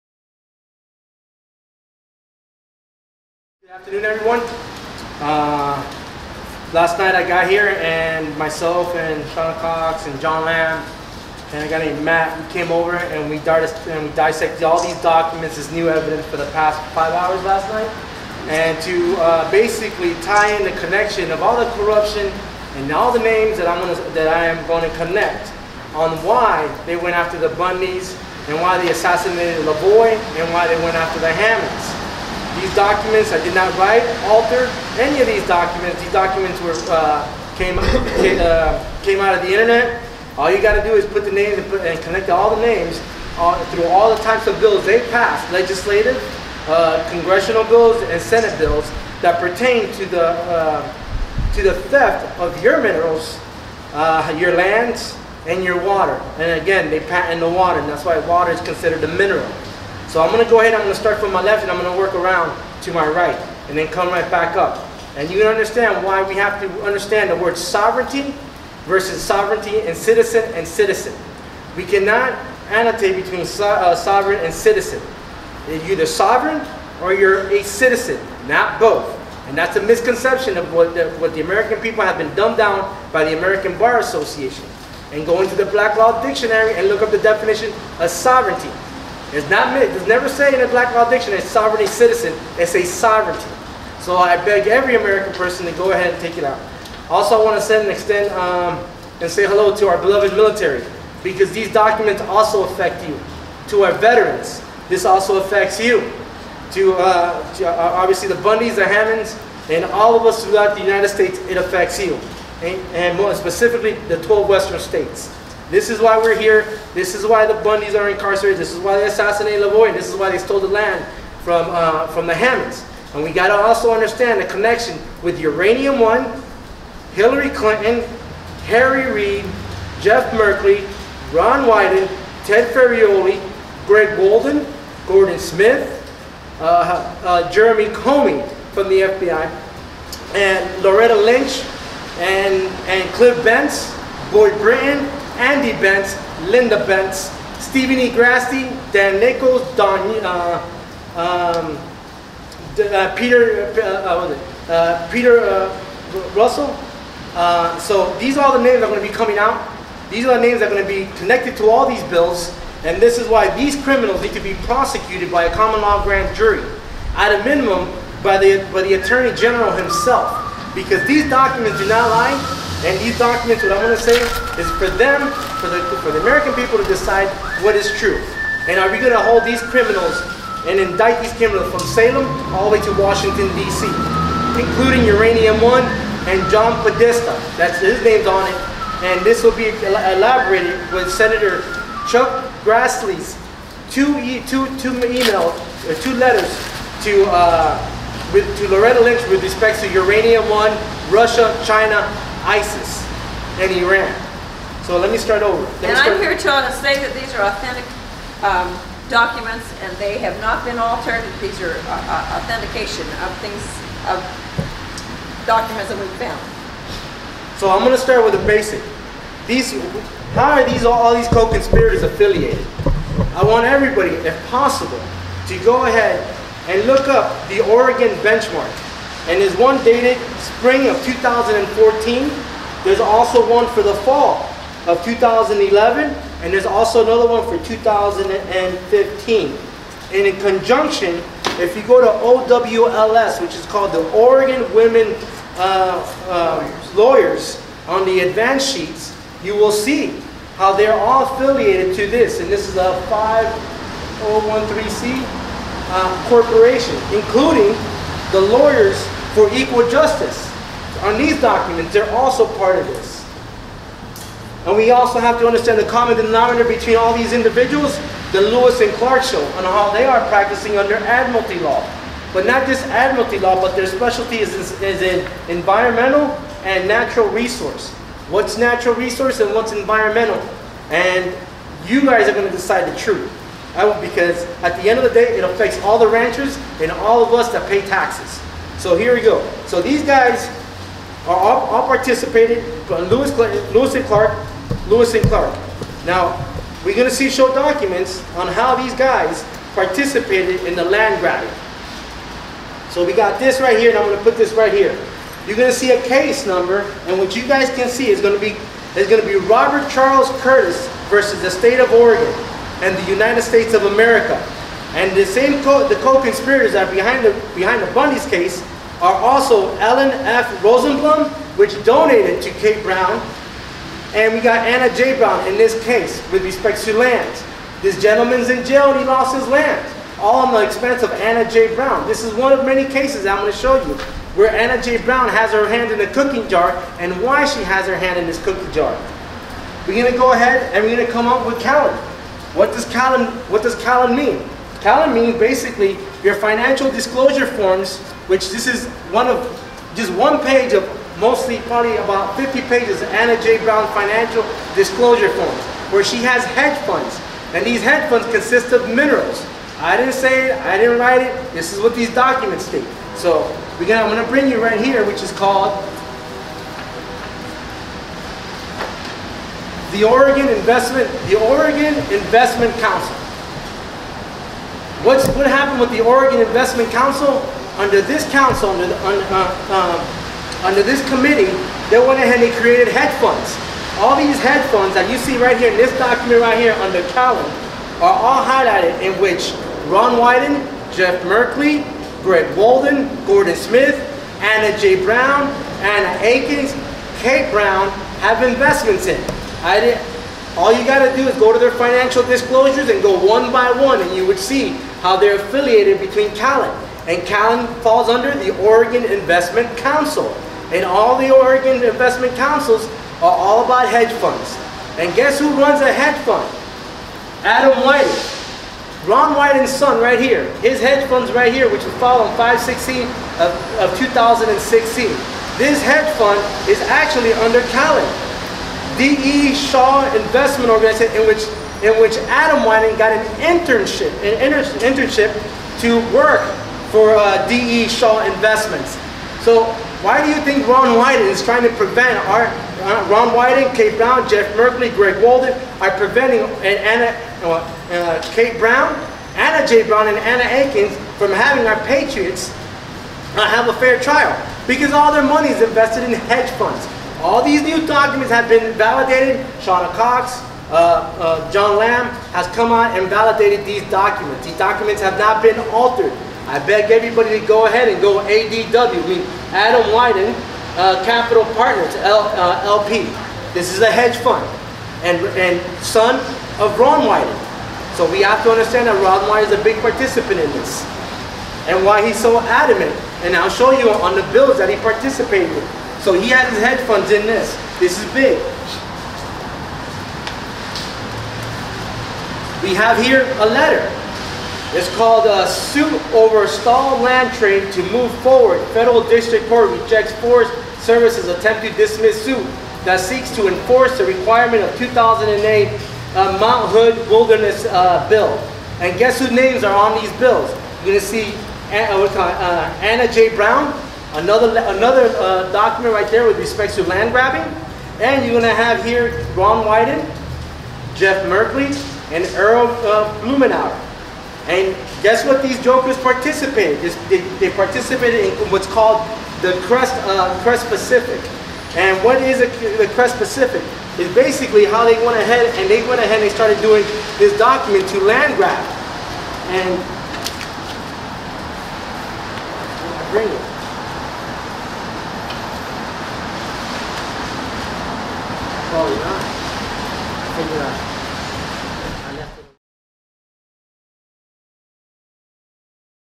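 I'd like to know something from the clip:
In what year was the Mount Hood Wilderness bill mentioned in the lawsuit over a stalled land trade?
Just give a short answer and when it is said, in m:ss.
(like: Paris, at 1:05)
2008, at 8:24.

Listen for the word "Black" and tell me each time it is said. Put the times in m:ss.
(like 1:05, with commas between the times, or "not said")
1:25, 1:30.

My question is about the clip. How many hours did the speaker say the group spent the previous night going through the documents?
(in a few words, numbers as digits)
5.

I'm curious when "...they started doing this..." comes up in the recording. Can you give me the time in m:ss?
8:56.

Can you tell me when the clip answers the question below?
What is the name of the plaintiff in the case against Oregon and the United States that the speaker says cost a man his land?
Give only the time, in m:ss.
5:09.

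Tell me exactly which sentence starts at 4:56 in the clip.
Now, we're going to see show documents on how these guys participated in the land grabbing.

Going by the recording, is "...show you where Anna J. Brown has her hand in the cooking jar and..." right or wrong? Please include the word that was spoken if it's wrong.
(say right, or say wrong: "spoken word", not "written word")
right.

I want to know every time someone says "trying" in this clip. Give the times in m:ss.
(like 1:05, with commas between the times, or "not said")
7:21.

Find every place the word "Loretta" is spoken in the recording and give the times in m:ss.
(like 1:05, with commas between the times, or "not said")
2:20, 3:18.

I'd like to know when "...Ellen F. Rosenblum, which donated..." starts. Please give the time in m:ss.
5:19.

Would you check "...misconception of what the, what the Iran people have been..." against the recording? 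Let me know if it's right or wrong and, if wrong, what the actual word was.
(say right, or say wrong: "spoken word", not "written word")
wrong: "American", not "Iran".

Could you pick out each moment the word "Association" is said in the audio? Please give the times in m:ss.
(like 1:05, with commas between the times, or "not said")
1:23.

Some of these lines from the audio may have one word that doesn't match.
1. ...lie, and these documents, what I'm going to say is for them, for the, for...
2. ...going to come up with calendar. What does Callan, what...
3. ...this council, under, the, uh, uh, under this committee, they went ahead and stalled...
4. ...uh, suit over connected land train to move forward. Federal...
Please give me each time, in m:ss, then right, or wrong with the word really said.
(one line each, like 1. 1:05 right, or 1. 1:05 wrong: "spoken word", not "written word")
1. 2:52 right
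2. 5:40 right
3. 6:18 wrong: "created", not "stalled"
4. 8:15 wrong: "stalled", not "connected".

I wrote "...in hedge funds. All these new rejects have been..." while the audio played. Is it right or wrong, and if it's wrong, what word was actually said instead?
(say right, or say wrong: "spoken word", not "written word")
wrong: "documents", not "rejects".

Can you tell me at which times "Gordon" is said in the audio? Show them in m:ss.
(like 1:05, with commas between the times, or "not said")
2:15, 6:33.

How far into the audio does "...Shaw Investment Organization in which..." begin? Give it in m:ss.
7:09.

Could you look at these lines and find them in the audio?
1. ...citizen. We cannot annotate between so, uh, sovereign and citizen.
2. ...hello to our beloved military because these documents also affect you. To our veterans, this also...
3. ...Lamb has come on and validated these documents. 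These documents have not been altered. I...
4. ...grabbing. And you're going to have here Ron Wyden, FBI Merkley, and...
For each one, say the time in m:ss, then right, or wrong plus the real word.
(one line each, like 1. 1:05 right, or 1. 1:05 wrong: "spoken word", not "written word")
1. 1:10 right
2. 1:39 right
3. 7:41 right
4. 8:37 wrong: "Jeff", not "FBI".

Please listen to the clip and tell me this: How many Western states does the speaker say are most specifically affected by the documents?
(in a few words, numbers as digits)
12.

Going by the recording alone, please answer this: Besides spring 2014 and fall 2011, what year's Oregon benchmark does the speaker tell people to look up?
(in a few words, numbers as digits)
2015.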